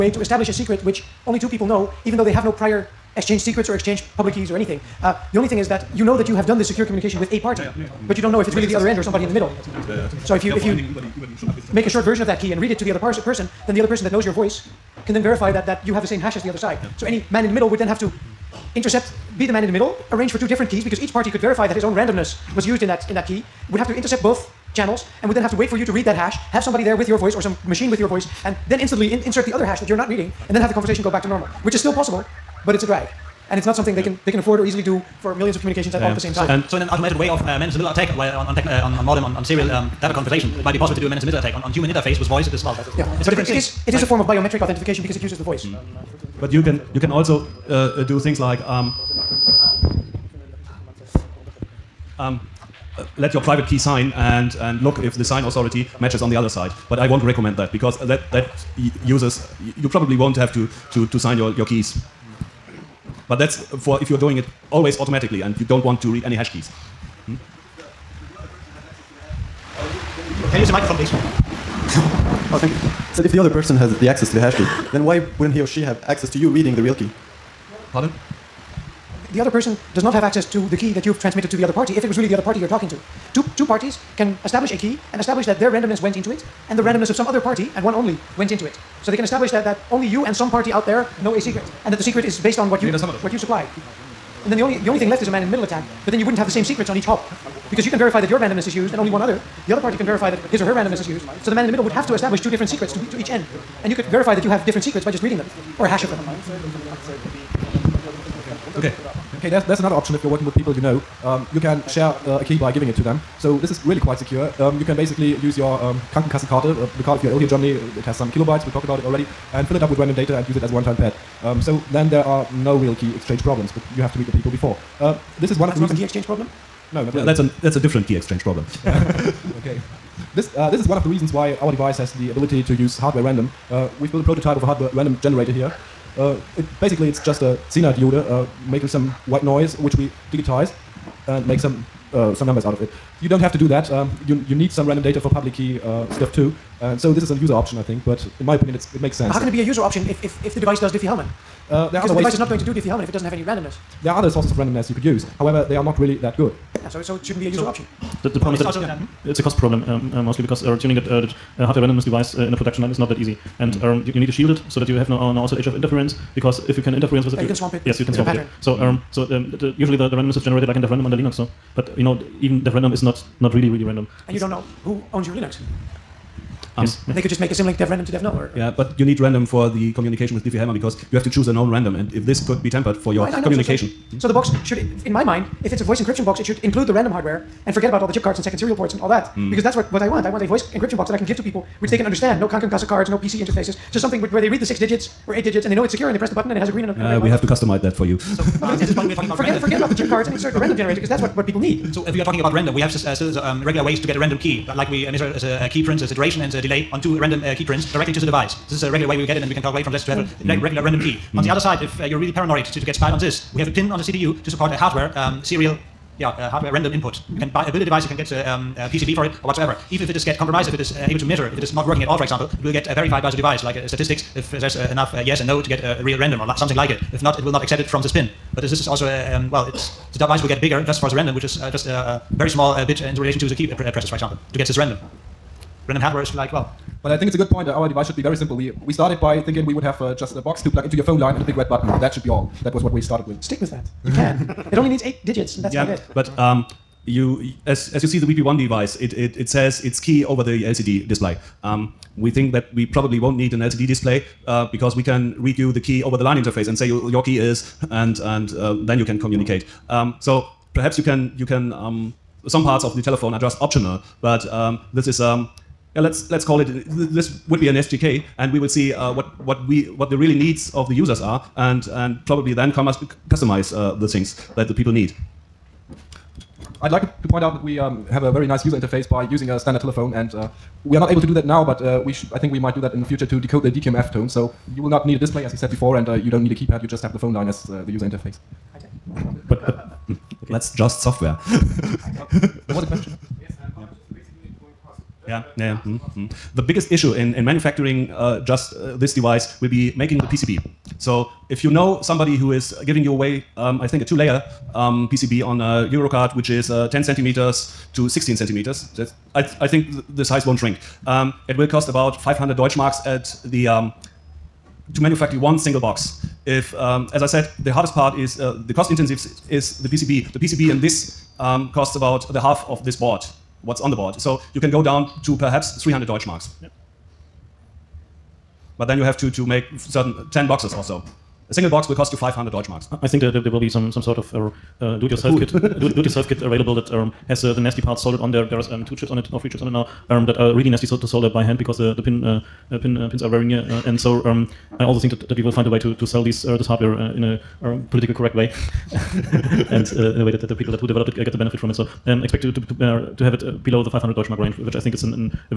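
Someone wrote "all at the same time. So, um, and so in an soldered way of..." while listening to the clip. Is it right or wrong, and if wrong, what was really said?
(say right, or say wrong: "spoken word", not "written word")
wrong: "automated", not "soldered".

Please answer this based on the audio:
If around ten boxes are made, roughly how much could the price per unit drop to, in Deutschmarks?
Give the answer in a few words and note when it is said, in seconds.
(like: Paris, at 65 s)
300 Deutschmarks, at 325 s.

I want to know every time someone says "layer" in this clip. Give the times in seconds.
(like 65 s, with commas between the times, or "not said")
304 s.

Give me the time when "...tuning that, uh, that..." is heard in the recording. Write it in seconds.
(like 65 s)
160 s.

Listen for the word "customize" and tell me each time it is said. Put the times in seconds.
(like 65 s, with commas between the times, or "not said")
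197 s, 273 s.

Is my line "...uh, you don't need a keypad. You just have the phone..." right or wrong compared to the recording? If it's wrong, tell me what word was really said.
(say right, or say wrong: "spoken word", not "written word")
right.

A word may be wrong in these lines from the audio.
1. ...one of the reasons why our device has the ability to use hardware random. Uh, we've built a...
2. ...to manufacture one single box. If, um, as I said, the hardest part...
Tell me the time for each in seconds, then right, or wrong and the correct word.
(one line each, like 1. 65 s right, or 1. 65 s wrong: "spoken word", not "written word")
1. 130 s right
2. 314 s right.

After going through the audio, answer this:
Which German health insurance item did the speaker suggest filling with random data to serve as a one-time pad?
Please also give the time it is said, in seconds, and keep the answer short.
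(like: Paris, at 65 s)
Krankenkassenkarte, at 116 s.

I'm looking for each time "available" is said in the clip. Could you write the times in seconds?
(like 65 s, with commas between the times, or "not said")
336 s.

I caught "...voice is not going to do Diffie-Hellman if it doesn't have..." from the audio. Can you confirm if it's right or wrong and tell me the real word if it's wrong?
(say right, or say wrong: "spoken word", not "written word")
wrong: "device", not "voice".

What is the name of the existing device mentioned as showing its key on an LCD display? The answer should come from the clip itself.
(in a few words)
VP1.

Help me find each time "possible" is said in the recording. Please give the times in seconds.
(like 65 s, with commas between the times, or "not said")
31 s, 40 s.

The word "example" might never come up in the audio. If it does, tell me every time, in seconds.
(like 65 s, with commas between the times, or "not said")
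222 s, 234 s.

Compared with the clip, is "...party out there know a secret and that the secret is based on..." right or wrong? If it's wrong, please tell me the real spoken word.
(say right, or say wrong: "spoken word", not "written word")
right.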